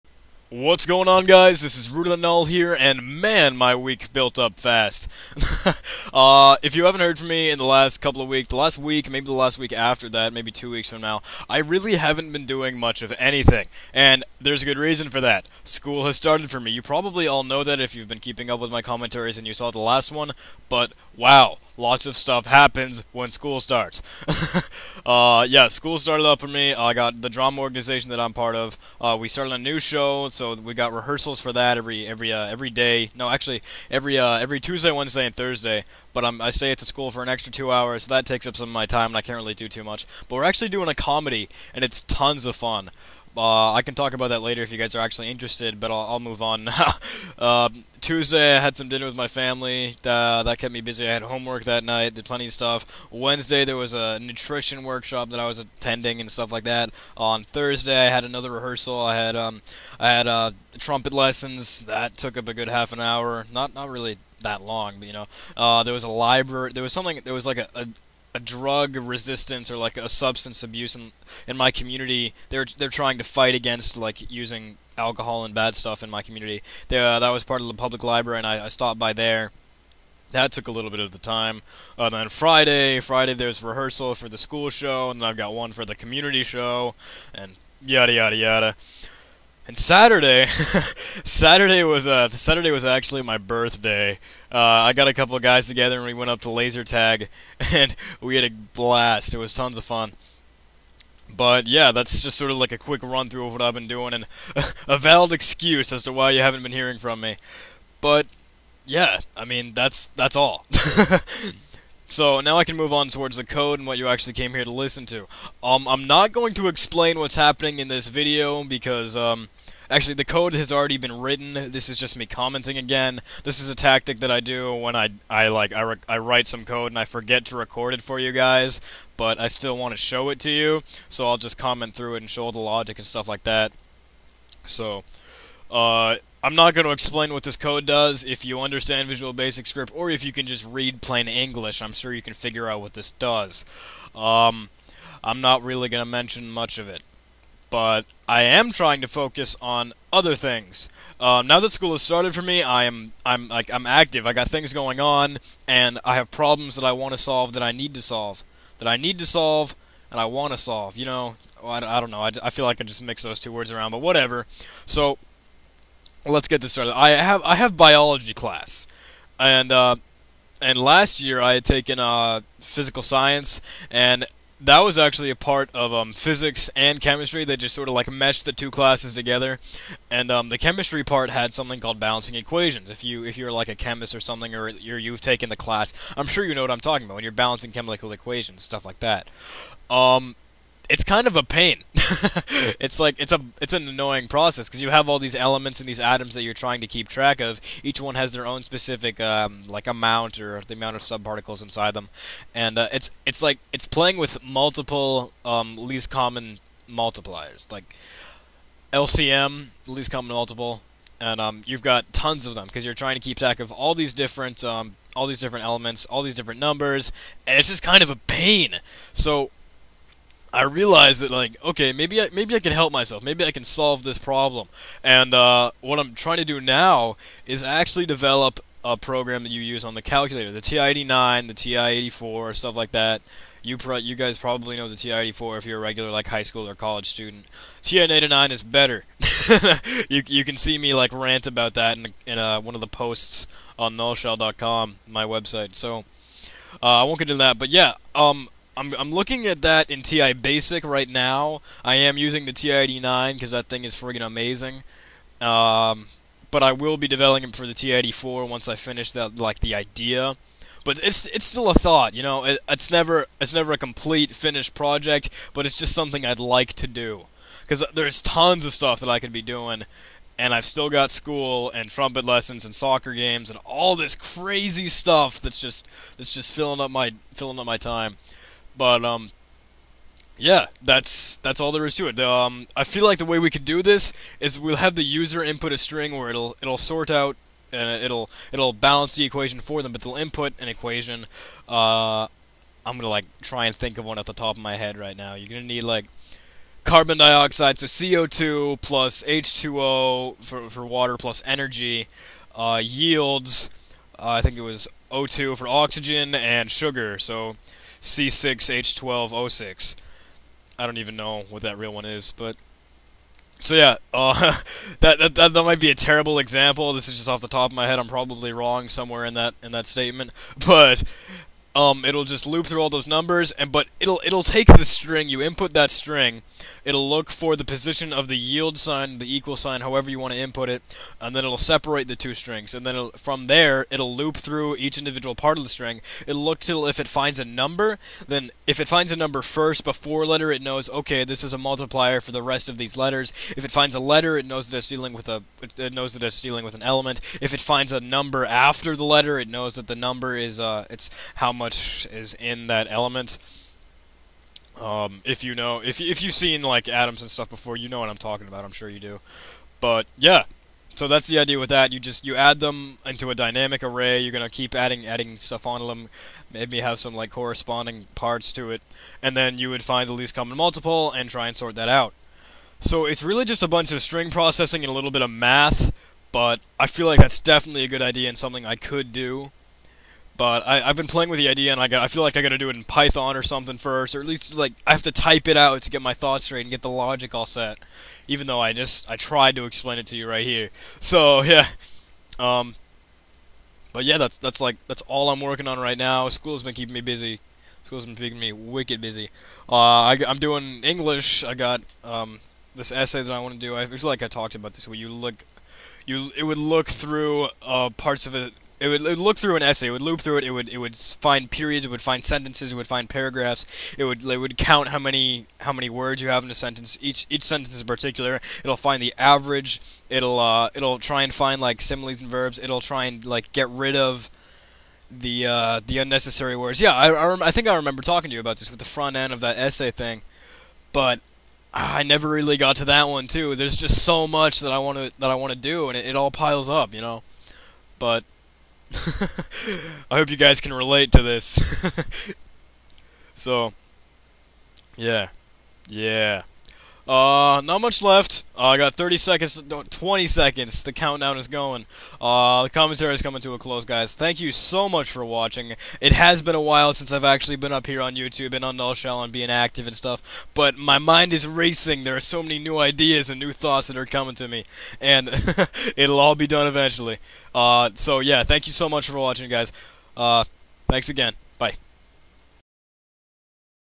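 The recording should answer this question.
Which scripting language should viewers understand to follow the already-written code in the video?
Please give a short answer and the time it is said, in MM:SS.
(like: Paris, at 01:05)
Visual Basic Script, at 02:19.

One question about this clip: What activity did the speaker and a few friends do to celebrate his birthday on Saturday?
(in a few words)
Laser tag.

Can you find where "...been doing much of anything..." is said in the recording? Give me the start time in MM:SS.
00:12.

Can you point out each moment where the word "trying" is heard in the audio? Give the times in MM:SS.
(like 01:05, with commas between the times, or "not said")
01:12, 02:28, 03:16, 03:32, 03:46.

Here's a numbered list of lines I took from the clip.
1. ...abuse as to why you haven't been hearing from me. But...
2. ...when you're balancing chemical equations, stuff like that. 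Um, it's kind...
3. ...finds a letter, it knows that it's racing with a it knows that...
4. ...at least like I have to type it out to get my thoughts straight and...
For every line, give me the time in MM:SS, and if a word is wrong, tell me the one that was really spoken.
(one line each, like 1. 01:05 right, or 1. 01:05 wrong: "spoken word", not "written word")
1. 01:45 wrong: "excuse", not "abuse"
2. 03:07 right
3. 05:43 wrong: "dealing", not "racing"
4. 06:24 right.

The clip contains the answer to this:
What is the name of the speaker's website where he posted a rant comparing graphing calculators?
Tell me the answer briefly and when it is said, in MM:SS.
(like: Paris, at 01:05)
nullshell.com, at 04:03.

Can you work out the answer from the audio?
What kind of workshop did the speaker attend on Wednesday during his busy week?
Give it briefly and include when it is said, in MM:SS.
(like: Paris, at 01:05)
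Nutrition workshop, at 00:54.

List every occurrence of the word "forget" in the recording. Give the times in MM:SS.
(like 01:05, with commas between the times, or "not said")
02:07.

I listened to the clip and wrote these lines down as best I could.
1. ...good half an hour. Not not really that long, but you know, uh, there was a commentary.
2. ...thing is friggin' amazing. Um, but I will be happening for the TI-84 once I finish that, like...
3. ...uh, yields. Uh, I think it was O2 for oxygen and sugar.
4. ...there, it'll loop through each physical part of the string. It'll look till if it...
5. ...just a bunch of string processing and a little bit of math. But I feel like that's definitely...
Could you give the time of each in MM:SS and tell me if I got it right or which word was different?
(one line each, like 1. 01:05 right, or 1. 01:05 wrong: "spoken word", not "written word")
1. 01:02 wrong: "library", not "commentary"
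2. 04:13 wrong: "developing", not "happening"
3. 05:02 right
4. 05:33 wrong: "individual", not "physical"
5. 06:13 right.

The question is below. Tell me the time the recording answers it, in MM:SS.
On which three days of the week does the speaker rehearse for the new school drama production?
00:34.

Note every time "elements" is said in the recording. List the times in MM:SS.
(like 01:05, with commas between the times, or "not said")
03:15, 03:35, 05:46, 05:52.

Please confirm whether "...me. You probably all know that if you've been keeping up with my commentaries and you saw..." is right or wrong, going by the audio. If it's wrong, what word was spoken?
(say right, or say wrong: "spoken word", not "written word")
right.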